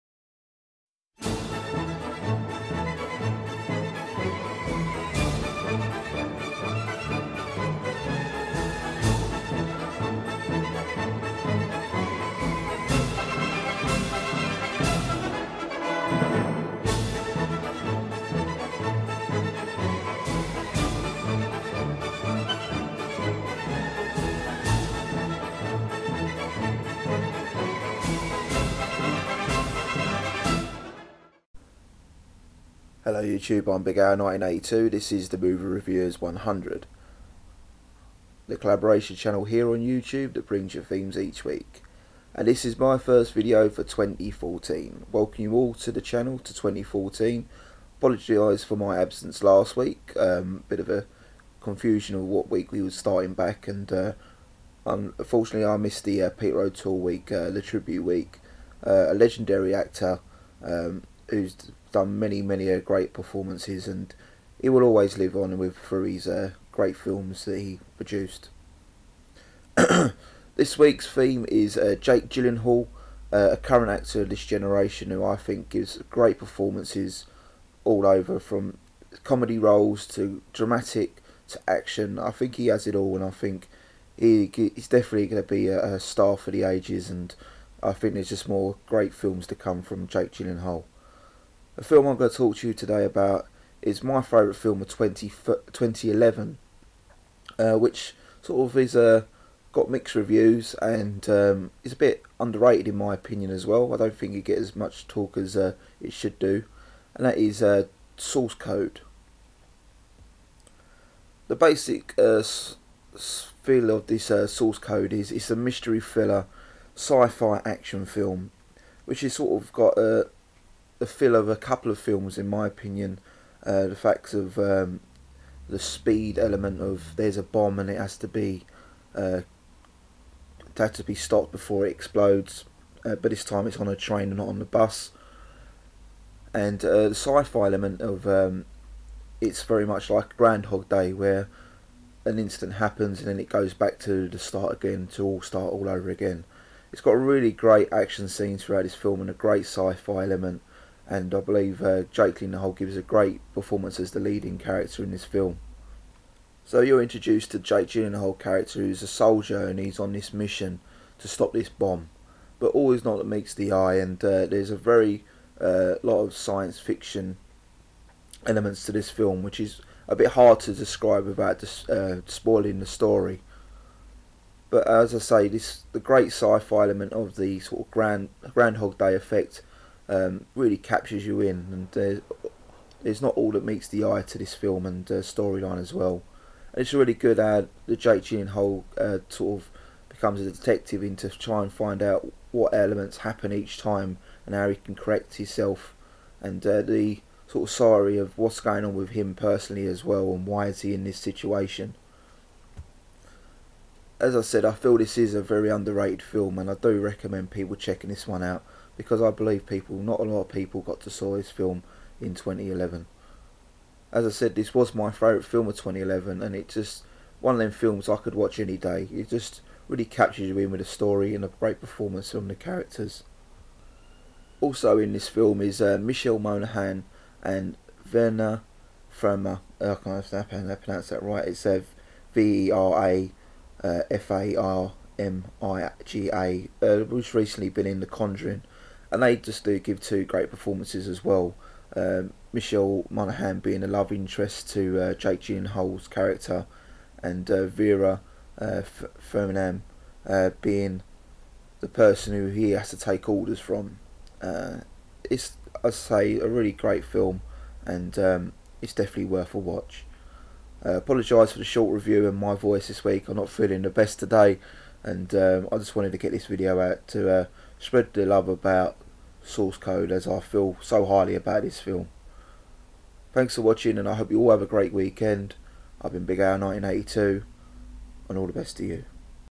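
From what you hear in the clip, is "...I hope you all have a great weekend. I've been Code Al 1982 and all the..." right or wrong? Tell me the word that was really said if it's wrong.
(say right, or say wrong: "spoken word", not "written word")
wrong: "Big", not "Code".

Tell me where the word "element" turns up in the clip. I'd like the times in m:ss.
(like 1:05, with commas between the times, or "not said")
2:06, 2:17, 2:30, 2:48, 2:56, 3:12.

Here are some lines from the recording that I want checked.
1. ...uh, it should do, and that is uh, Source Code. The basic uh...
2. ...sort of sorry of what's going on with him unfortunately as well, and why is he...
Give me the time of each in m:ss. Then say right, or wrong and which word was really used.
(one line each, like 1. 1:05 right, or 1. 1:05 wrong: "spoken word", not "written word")
1. 1:45 right
2. 3:17 wrong: "personally", not "unfortunately".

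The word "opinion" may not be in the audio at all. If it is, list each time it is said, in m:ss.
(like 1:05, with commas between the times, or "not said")
1:43, 2:02.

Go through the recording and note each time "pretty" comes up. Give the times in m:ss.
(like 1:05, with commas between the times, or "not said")
not said.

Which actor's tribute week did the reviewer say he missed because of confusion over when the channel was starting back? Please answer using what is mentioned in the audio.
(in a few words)
Peter O'Toole.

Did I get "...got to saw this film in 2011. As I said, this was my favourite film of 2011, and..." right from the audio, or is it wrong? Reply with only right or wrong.
right.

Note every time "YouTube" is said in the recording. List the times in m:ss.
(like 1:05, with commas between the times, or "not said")
0:33, 0:39.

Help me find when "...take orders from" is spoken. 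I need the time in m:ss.
4:12.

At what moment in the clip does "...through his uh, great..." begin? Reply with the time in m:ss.
1:05.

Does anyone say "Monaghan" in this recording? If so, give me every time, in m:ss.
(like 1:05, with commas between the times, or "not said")
3:46, 4:03.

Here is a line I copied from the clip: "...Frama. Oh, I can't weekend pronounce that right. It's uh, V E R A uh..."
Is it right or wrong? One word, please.
wrong.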